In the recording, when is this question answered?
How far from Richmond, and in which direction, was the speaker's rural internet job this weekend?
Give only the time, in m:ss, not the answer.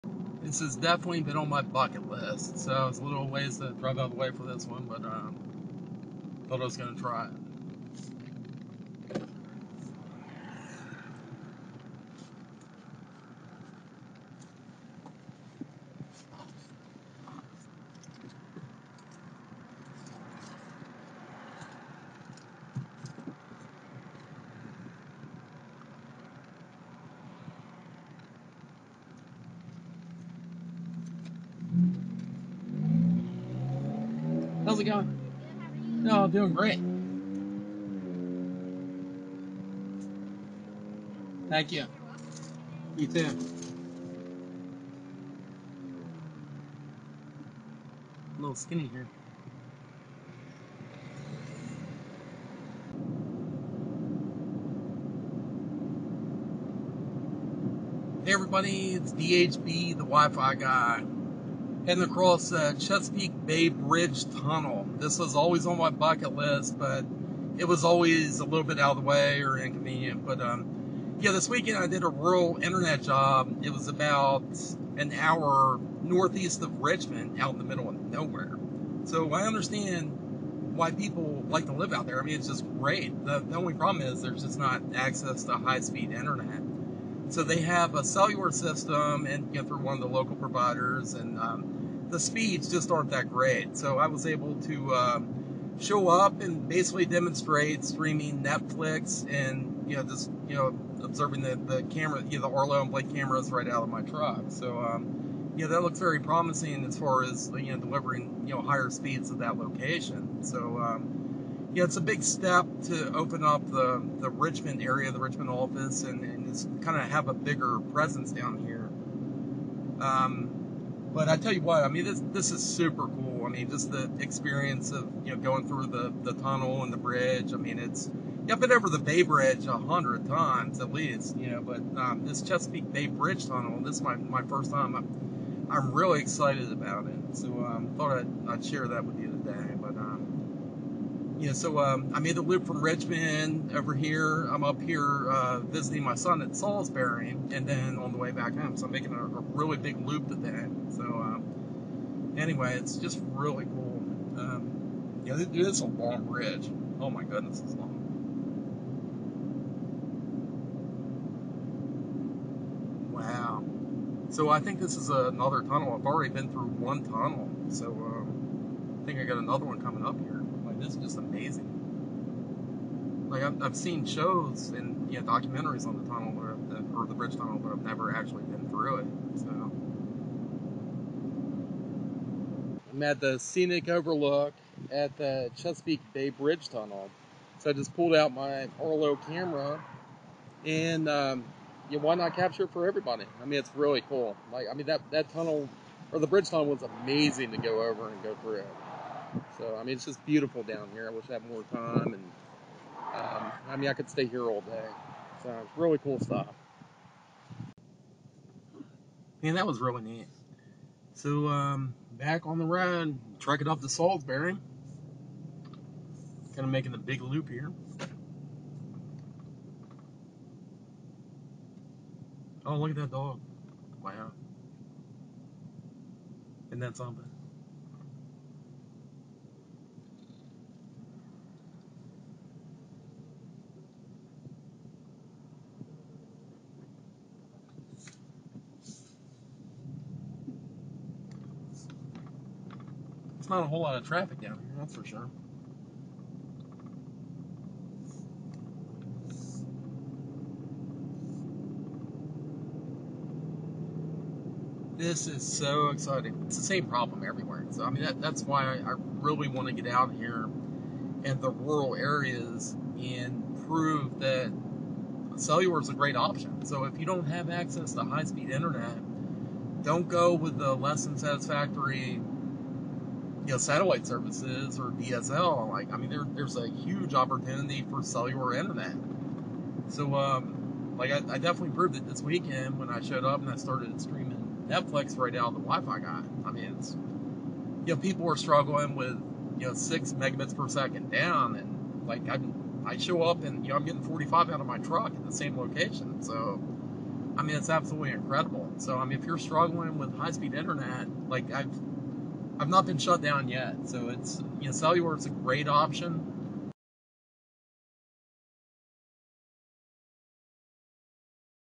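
1:13.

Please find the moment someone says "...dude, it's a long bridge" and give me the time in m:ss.
2:35.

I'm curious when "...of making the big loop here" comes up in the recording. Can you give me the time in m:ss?
3:36.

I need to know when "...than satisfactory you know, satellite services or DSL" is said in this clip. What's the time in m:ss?
4:31.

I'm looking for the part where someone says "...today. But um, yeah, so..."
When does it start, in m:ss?
2:19.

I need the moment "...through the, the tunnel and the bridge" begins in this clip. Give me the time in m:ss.
2:05.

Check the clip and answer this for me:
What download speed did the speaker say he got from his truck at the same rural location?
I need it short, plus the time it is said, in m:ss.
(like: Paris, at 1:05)
45, at 4:54.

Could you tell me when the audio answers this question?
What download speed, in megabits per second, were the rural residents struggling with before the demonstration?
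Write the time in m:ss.
4:49.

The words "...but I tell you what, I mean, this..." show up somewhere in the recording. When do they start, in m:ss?
2:01.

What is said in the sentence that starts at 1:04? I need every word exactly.
This was always on my bucket list, but it was always a little bit out of the way or inconvenient.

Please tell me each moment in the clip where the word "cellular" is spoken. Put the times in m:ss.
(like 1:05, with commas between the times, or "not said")
1:28, 4:25, 4:38, 5:04.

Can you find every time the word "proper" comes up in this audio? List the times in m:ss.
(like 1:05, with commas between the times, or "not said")
not said.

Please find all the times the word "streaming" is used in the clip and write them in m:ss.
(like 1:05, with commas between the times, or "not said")
1:37, 4:43.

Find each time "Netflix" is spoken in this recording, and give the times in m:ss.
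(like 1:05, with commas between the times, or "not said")
1:38, 4:44.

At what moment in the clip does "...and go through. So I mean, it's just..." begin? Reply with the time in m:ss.
3:18.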